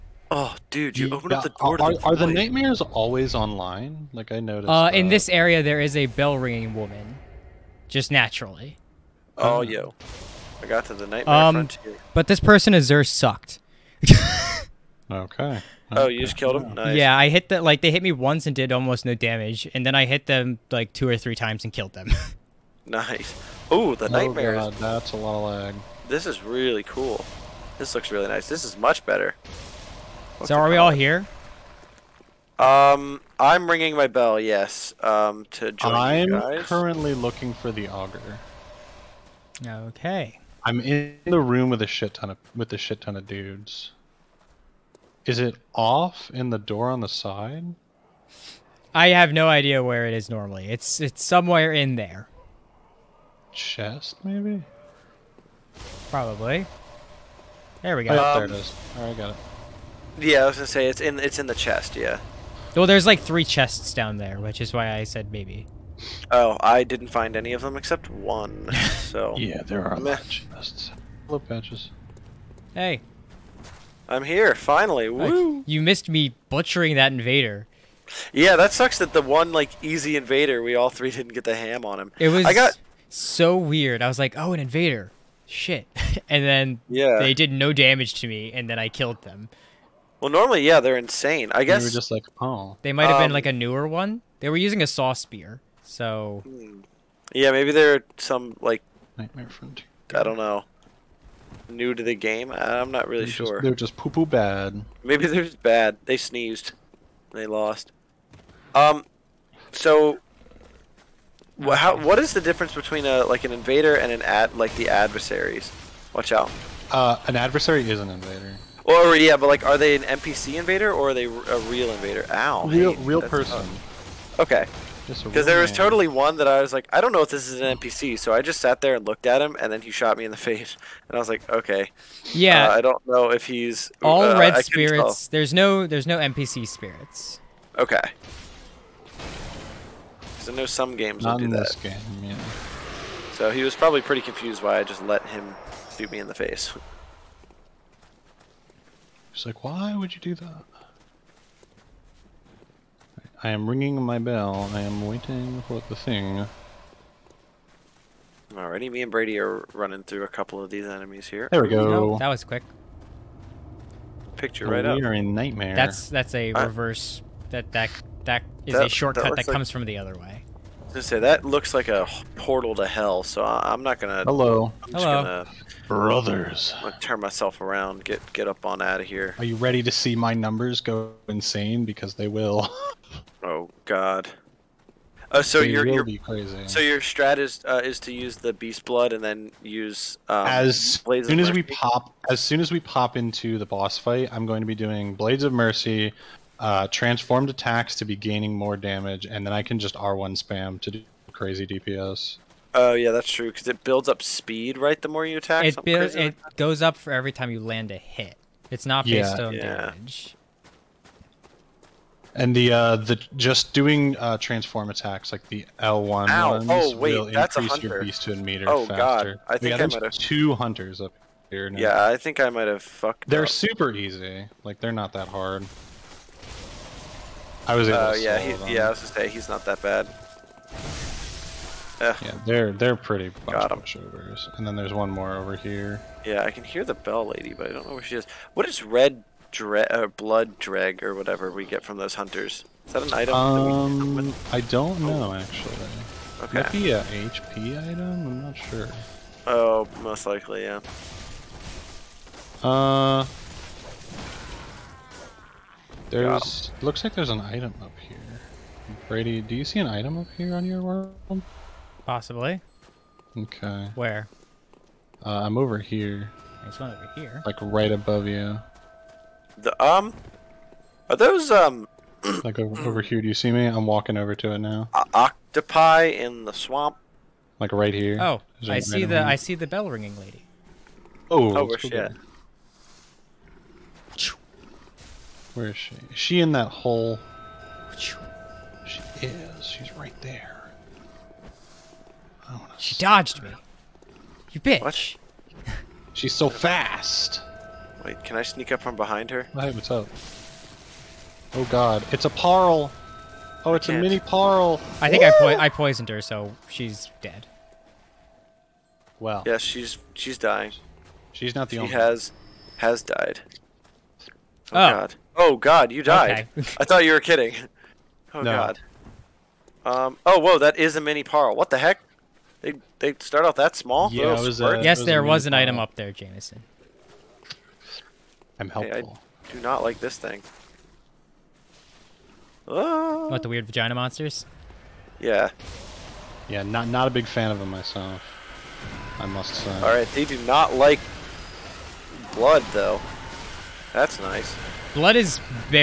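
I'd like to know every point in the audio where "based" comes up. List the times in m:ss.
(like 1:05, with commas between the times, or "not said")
3:29.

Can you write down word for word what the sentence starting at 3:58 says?
What is red dre blood dreg or whatever we get from those hunters?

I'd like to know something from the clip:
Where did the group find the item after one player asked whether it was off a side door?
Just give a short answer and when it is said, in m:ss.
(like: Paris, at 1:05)
In the chest, at 1:01.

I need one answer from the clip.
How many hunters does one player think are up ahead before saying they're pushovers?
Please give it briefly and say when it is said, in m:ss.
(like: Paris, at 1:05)
2, at 3:40.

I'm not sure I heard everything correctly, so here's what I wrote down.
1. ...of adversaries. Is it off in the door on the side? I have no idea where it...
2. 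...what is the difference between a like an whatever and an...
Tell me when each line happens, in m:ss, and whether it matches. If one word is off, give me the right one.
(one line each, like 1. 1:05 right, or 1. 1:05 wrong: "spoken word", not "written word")
1. 0:43 wrong: "dudes", not "adversaries"
2. 1:51 wrong: "invader", not "whatever".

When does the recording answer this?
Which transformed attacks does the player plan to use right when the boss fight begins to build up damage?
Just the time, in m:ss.
3:15.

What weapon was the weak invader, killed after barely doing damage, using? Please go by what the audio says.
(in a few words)
Saw spear.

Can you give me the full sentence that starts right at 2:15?
There's no there's no NPC spirits.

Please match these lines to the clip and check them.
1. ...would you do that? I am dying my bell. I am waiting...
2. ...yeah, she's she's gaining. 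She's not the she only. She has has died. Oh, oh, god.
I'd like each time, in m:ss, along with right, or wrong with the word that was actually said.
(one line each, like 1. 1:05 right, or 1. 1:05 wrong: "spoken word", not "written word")
1. 2:29 wrong: "ringing", not "dying"
2. 5:09 wrong: "dying", not "gaining".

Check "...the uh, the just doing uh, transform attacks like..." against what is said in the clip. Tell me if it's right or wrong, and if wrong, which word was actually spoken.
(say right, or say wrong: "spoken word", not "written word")
right.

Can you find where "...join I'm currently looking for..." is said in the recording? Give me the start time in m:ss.
0:35.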